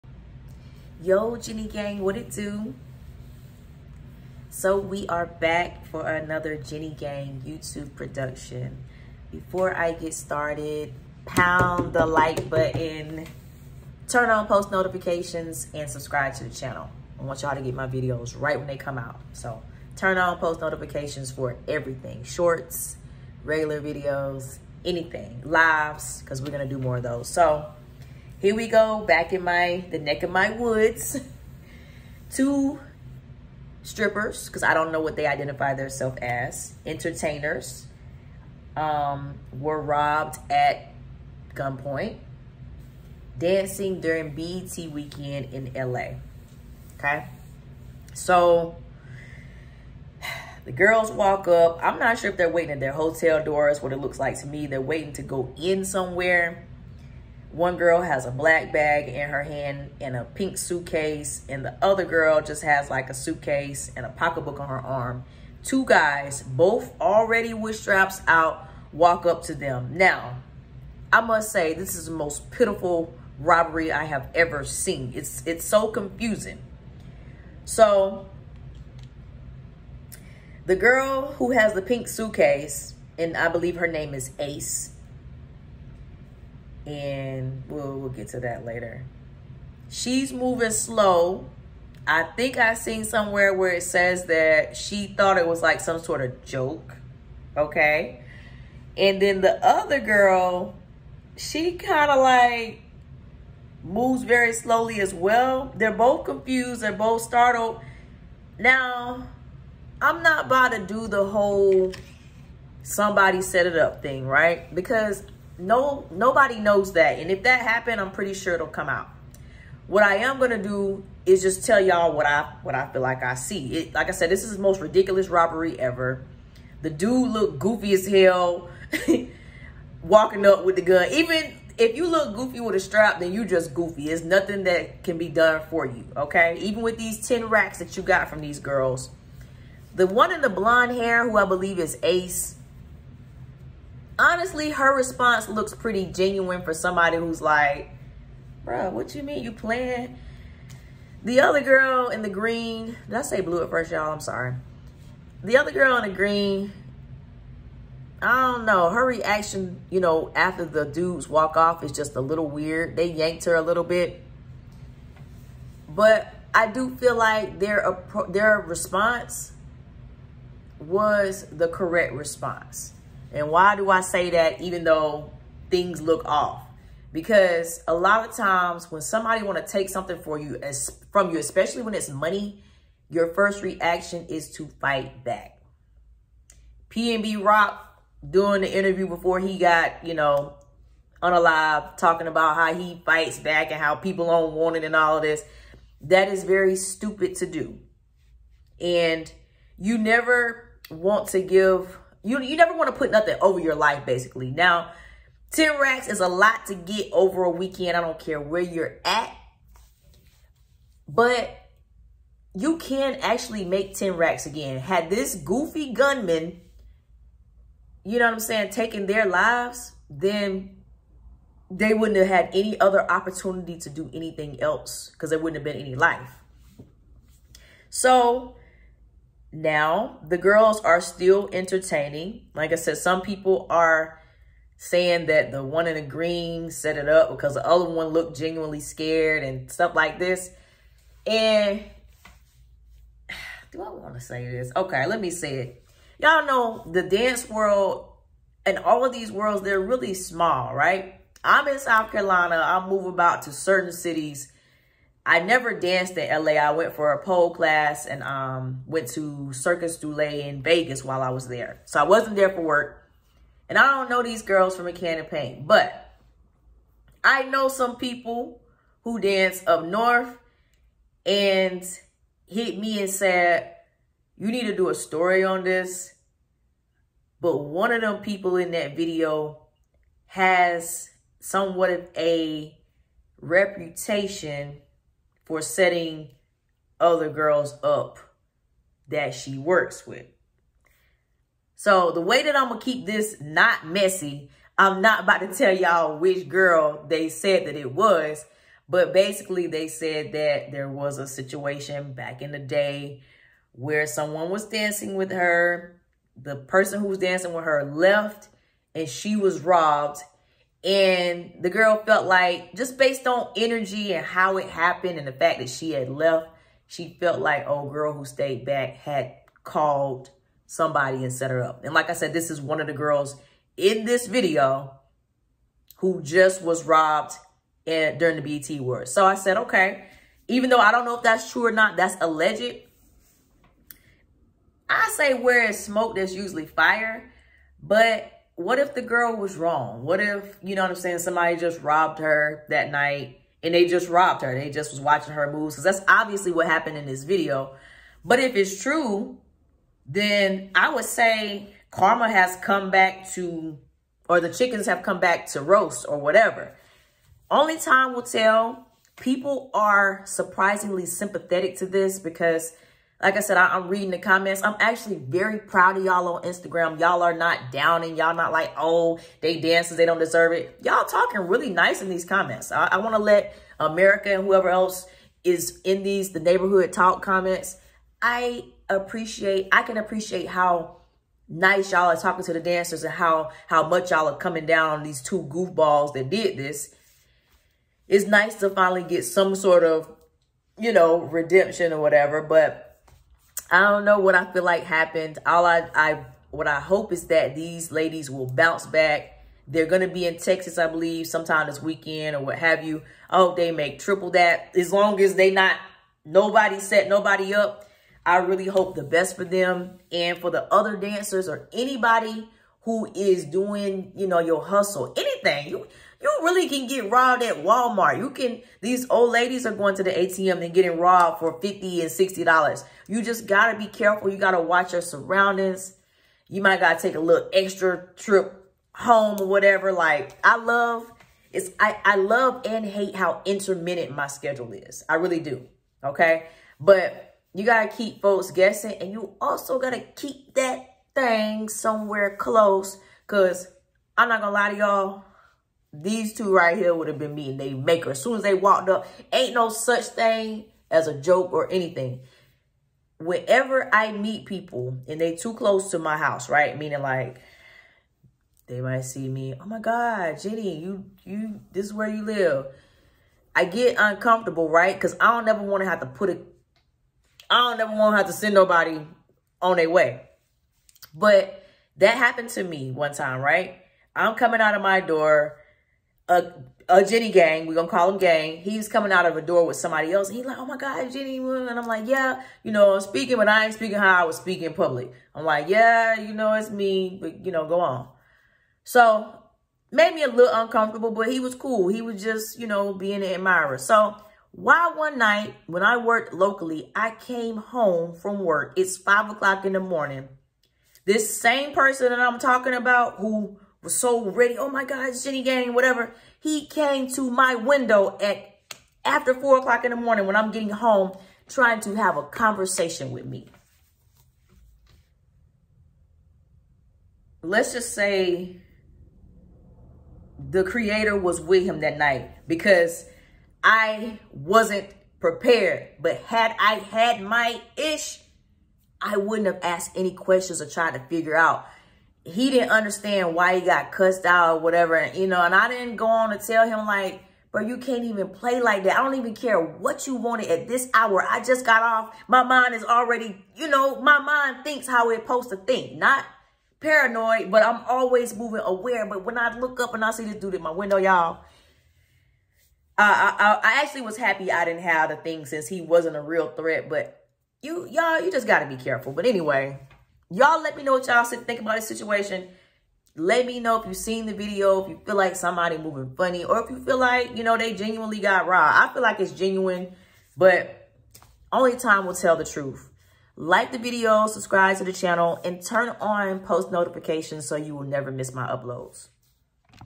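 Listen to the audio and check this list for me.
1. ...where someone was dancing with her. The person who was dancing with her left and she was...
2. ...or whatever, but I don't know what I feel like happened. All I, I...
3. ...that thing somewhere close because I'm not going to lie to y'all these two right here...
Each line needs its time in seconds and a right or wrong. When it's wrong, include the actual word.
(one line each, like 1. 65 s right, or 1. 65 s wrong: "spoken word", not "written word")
1. 303 s right
2. 391 s right
3. 440 s right.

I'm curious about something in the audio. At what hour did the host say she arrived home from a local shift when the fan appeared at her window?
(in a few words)
5 o'clock.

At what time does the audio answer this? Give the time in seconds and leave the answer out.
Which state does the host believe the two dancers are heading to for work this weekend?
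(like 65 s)
400 s.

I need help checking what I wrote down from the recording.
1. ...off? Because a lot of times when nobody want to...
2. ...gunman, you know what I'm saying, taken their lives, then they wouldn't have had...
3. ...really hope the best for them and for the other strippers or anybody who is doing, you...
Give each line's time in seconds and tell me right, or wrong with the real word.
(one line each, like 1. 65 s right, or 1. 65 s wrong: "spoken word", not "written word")
1. 176 s wrong: "somebody", not "nobody"
2. 215 s right
3. 408 s wrong: "dancers", not "strippers".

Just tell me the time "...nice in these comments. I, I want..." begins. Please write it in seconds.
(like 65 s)
371 s.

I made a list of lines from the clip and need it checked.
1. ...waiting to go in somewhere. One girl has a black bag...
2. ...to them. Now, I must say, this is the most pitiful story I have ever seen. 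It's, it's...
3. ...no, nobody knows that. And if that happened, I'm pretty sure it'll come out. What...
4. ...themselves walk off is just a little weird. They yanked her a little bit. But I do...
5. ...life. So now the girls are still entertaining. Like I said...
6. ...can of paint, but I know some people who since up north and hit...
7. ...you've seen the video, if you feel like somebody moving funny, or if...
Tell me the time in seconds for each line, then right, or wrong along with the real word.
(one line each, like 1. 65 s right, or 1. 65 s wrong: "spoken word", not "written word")
1. 54 s right
2. 69 s wrong: "robbery", not "story"
3. 115 s right
4. 160 s wrong: "dudes", not "themselves"
5. 225 s right
6. 264 s wrong: "dance", not "since"
7. 563 s right.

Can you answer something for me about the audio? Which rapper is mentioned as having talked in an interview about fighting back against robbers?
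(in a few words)
PNB Rock.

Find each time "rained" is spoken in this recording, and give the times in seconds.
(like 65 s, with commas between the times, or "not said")
not said.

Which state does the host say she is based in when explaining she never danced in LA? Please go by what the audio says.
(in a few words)
South Carolina.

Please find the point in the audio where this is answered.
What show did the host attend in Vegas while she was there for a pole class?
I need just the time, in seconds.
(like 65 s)
259 s.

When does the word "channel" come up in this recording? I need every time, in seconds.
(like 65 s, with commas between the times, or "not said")
16 s, 574 s.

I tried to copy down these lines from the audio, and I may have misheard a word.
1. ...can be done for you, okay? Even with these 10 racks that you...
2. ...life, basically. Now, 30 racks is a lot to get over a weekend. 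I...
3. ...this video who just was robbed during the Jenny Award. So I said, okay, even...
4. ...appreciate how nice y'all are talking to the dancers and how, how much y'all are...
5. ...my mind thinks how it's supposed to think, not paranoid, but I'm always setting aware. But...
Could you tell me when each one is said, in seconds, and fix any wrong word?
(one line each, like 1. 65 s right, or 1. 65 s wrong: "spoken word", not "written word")
1. 135 s right
2. 203 s wrong: "10", not "30"
3. 324 s wrong: "BET", not "Jenny"
4. 379 s right
5. 544 s wrong: "moving", not "setting".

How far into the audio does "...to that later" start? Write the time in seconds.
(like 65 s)
88 s.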